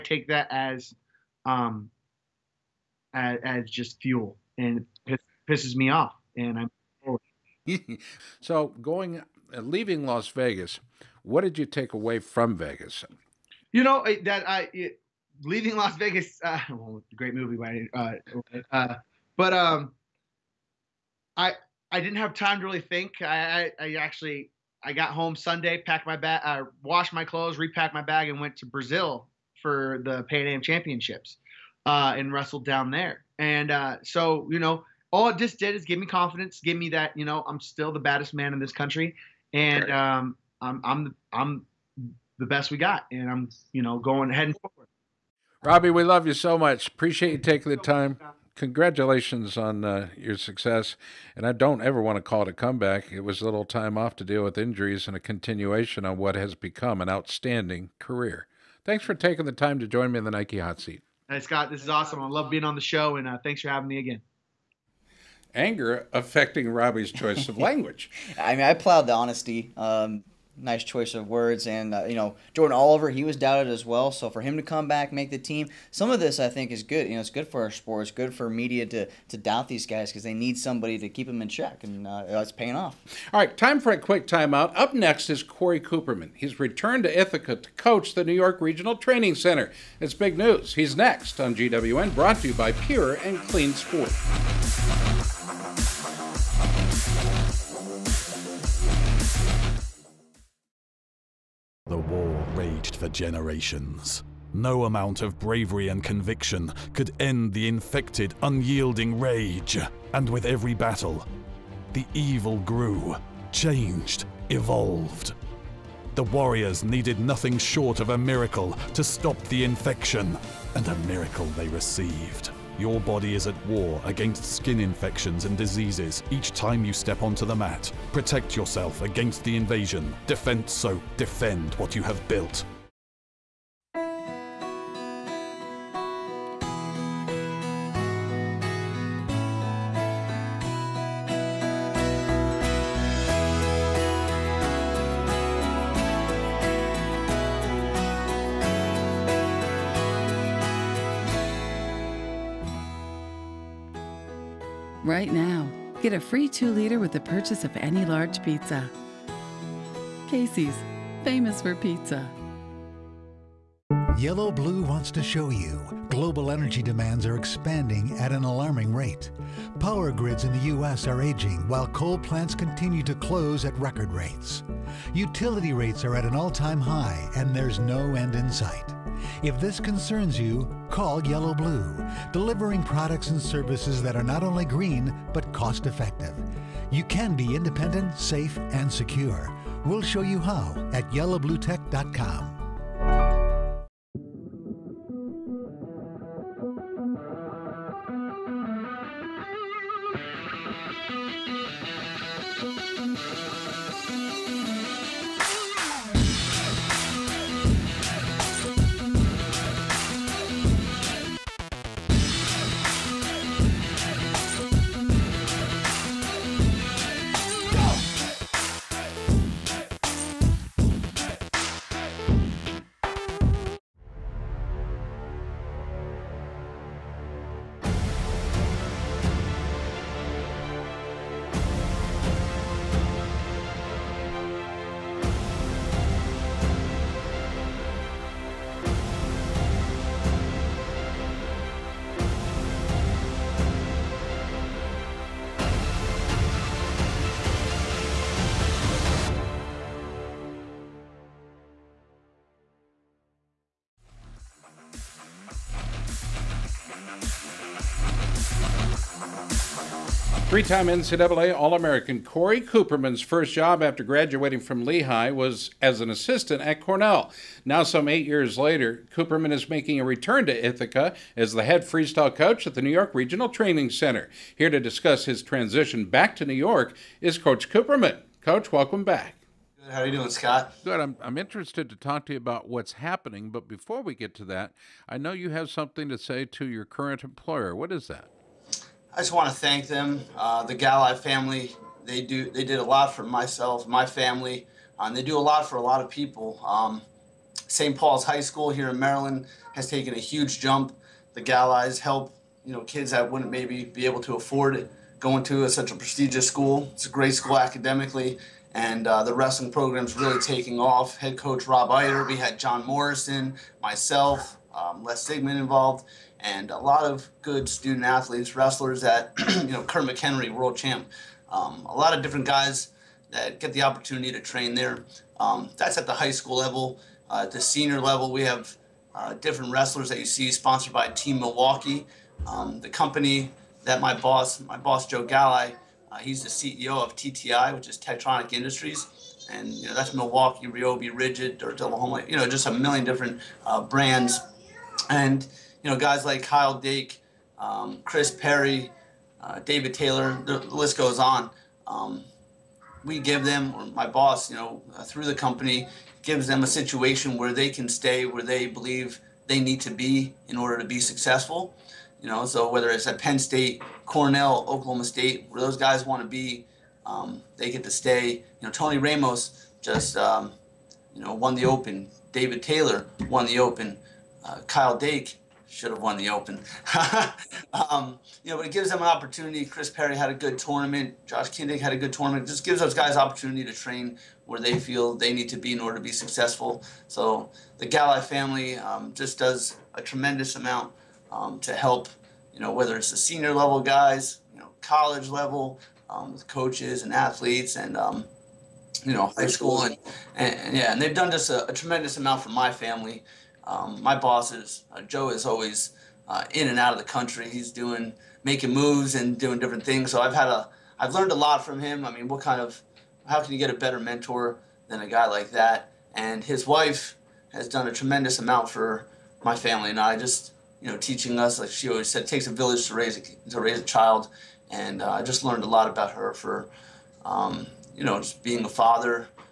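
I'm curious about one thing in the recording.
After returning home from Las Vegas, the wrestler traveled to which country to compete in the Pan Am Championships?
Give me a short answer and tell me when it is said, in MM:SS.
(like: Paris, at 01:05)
Brazil, at 00:28.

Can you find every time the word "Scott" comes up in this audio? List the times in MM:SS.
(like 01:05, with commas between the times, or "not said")
01:01, 04:40.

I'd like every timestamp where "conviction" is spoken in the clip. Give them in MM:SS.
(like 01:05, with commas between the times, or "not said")
01:46.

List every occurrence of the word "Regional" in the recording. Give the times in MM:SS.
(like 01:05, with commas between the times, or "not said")
01:28, 04:33.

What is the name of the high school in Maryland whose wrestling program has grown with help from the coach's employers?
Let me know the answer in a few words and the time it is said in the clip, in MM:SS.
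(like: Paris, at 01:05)
St. Paul's High School, at 04:57.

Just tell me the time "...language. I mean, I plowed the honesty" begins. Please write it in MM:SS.
01:07.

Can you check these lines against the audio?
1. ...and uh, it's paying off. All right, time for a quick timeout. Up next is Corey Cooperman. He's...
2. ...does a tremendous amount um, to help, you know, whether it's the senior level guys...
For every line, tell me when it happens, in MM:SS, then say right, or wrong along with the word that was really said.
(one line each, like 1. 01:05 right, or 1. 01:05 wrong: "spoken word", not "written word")
1. 01:21 right
2. 06:29 right.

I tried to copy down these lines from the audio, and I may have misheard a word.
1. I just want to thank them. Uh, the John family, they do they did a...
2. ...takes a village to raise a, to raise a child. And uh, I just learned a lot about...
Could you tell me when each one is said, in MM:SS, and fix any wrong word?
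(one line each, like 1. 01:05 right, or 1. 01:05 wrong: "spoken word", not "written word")
1. 04:49 wrong: "Galli", not "John"
2. 07:02 right.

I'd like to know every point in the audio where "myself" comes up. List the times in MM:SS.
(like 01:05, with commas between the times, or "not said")
04:53, 05:13.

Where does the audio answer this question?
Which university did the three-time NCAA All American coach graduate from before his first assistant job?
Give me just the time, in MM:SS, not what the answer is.
04:24.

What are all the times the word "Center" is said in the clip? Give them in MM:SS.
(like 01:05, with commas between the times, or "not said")
01:29, 04:33.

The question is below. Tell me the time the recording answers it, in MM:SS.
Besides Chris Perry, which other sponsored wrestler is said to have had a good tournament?
06:21.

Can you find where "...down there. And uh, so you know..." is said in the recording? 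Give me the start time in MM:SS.
00:32.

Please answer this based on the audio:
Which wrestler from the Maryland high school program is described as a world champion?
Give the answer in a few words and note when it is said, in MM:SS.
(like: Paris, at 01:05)
Kurt McHenry, at 05:19.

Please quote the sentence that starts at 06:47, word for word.
He's doing, making moves and doing different things.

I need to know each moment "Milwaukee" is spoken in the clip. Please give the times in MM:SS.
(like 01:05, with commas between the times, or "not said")
05:31, 05:40.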